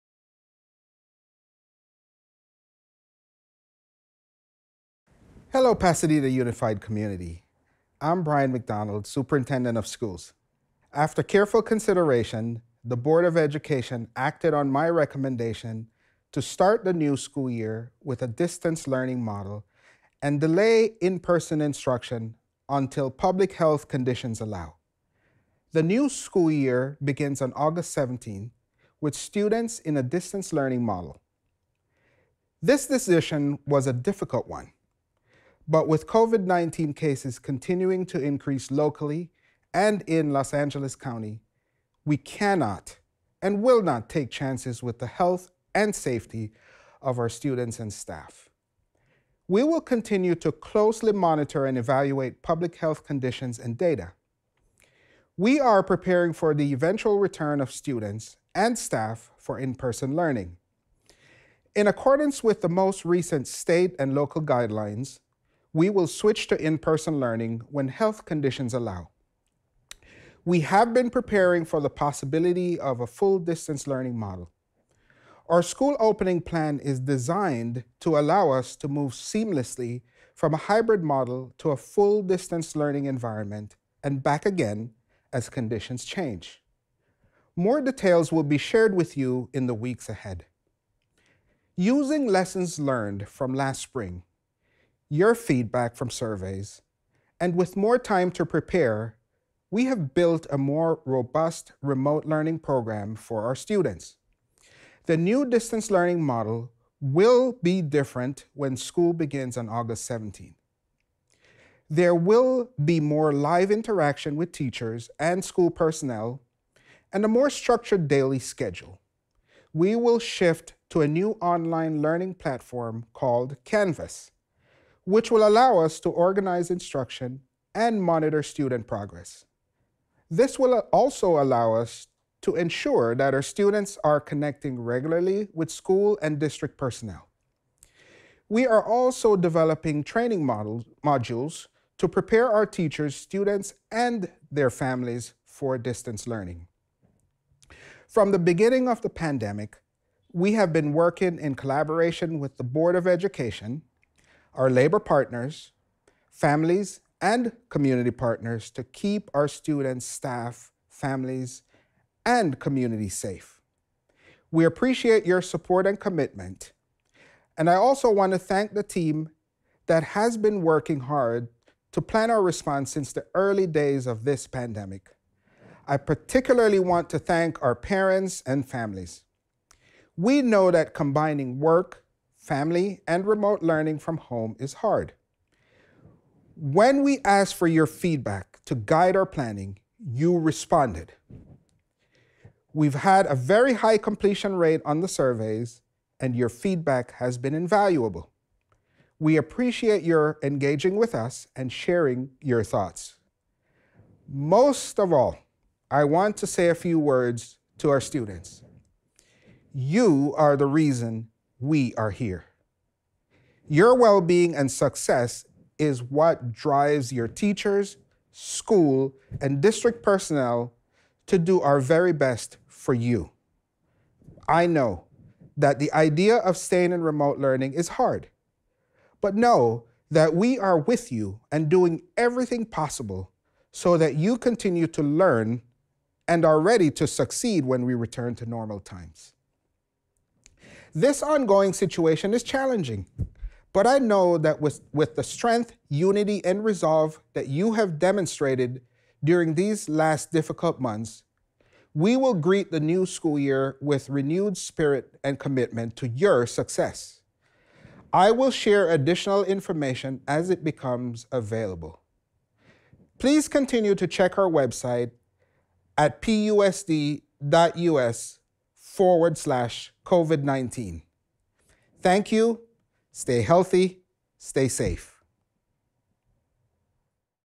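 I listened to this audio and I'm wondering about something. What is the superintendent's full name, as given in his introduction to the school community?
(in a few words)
Brian McDonald.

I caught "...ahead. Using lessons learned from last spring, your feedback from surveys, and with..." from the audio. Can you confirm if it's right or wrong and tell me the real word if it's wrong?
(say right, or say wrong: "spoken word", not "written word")
right.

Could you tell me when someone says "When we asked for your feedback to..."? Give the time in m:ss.
3:06.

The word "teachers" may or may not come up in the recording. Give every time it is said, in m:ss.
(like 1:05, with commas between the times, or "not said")
1:54, 2:22, 3:37.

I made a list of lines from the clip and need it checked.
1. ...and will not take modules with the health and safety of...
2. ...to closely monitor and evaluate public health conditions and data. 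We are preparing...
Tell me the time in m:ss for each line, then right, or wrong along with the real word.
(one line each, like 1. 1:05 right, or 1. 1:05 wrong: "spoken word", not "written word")
1. 0:43 wrong: "chances", not "modules"
2. 0:50 right.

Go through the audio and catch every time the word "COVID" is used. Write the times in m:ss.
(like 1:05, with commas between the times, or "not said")
0:36, 4:30.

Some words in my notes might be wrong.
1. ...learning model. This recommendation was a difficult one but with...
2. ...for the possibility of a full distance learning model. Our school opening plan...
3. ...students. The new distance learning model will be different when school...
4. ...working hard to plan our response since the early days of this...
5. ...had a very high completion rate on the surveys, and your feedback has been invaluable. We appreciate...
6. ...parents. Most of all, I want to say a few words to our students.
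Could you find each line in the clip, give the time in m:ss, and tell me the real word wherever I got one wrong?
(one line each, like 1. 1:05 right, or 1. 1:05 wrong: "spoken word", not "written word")
1. 0:30 wrong: "decision", not "recommendation"
2. 1:11 right
3. 1:43 right
4. 2:50 right
5. 3:12 right
6. 3:22 wrong: "thoughts", not "parents".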